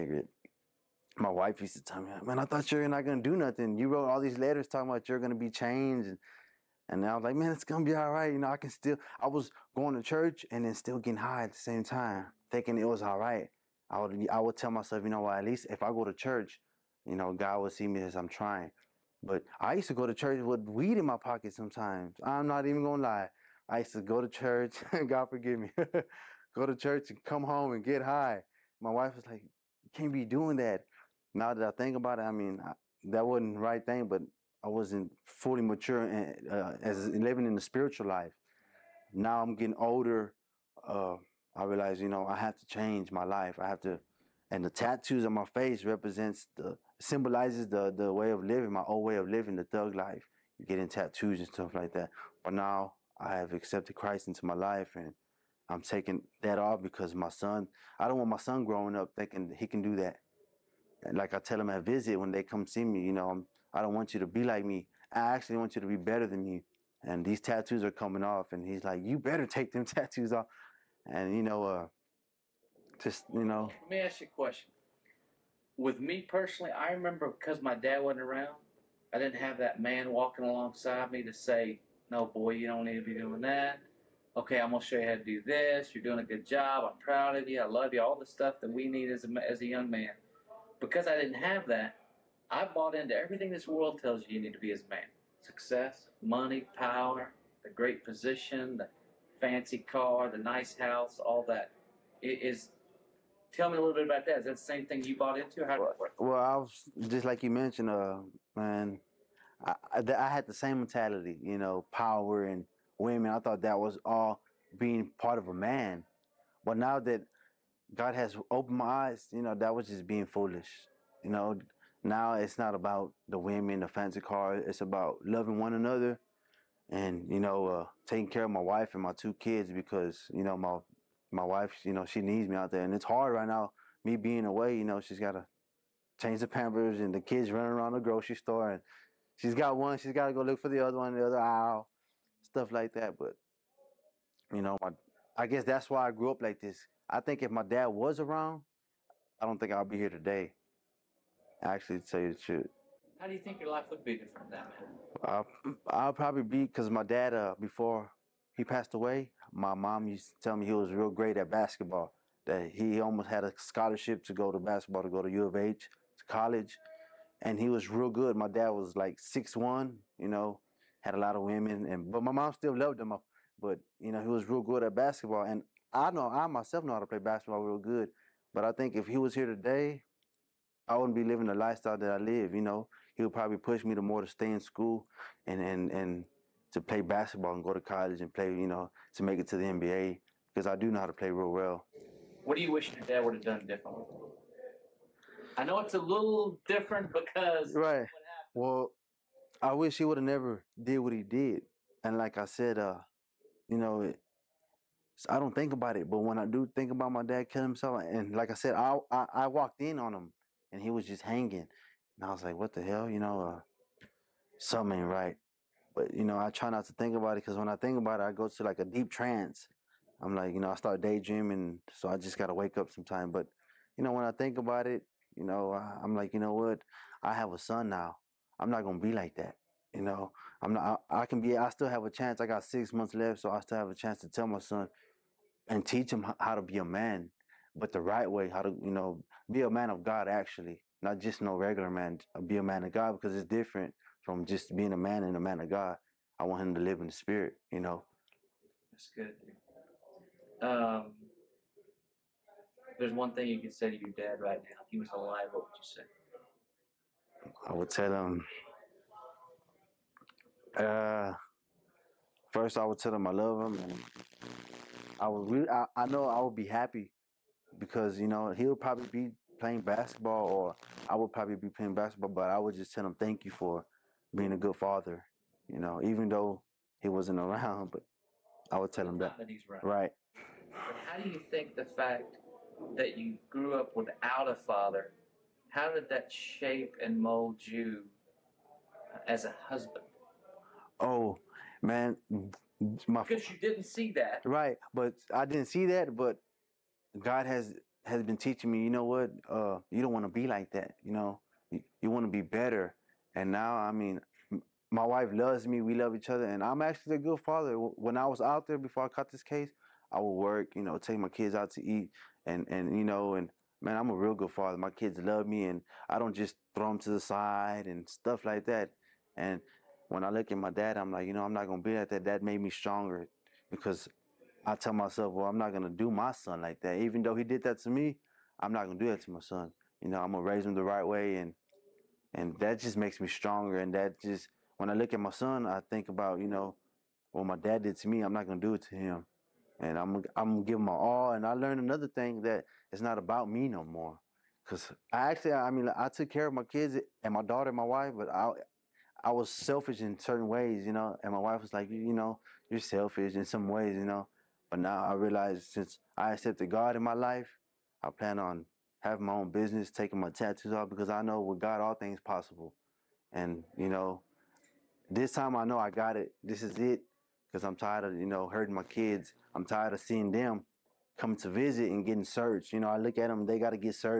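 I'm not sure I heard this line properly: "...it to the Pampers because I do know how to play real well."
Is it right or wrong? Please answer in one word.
wrong.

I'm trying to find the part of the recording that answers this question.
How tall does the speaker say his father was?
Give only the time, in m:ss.
2:49.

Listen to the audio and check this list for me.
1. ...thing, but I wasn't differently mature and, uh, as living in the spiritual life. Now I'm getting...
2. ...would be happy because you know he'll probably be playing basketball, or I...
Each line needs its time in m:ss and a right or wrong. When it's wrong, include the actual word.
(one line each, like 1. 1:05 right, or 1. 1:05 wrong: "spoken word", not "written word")
1. 0:33 wrong: "fully", not "differently"
2. 4:26 right.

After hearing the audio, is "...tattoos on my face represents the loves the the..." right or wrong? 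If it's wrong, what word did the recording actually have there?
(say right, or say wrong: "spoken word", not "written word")
wrong: "symbolizes", not "loves".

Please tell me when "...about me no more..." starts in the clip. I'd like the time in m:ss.
5:43.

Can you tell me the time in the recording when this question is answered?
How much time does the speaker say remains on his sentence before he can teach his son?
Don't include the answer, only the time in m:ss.
3:52.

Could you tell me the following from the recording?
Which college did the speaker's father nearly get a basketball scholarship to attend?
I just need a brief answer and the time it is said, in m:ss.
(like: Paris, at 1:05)
U of H, at 2:45.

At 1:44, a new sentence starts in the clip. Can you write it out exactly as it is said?
Is that the same thing you bought into?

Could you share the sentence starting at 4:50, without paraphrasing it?
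oh man, my because you didn't see that.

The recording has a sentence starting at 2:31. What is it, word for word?
Actually, to tell you the truth.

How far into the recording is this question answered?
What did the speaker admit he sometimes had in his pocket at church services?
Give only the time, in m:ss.
0:20.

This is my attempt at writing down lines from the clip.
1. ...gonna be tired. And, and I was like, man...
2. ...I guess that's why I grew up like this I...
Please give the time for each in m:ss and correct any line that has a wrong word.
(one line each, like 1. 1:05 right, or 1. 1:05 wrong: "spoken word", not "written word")
1. 0:05 wrong: "changed", not "tired"
2. 2:25 right.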